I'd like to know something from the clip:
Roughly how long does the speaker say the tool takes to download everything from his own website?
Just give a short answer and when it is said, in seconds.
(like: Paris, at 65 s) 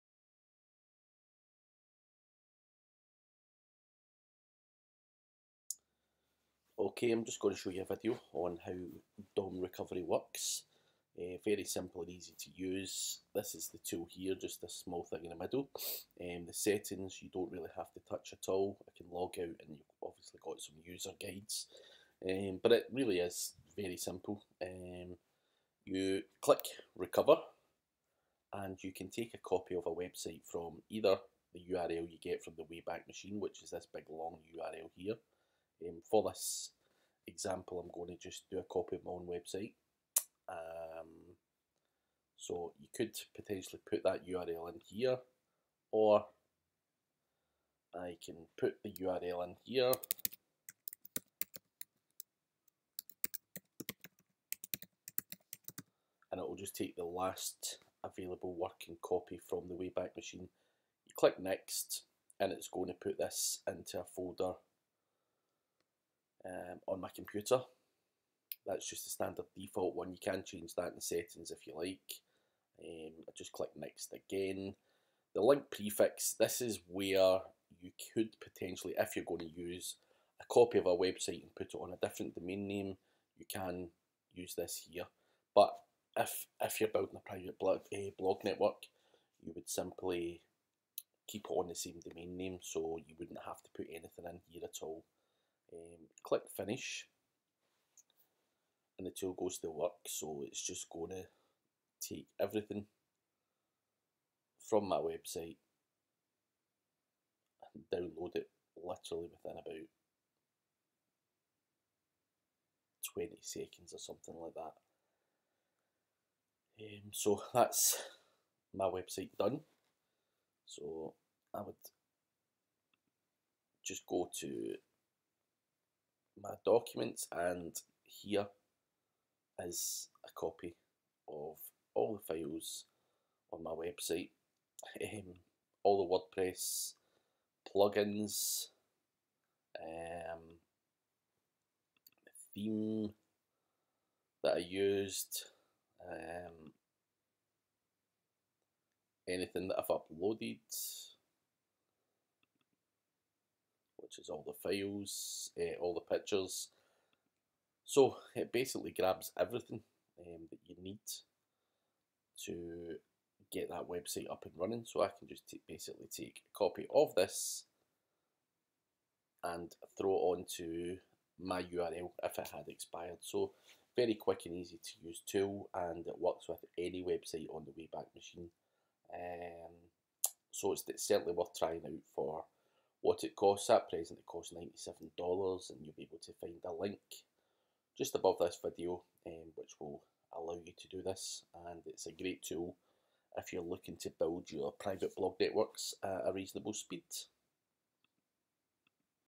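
about 20 seconds, at 109 s.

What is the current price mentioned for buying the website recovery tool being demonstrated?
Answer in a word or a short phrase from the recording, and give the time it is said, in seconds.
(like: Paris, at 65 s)
$97, at 184 s.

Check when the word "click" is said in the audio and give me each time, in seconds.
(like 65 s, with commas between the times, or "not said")
26 s, 61 s, 73 s, 96 s.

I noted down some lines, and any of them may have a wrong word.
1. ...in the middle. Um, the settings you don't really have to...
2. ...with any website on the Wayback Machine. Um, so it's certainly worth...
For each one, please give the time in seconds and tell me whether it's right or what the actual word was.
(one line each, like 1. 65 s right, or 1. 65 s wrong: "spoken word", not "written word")
1. 15 s right
2. 176 s right.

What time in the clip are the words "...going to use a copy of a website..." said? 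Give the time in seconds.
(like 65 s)
79 s.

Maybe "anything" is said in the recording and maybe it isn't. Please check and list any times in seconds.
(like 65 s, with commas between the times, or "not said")
93 s, 149 s.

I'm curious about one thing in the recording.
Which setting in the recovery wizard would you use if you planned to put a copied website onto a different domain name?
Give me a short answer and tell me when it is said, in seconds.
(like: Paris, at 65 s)
link prefix, at 75 s.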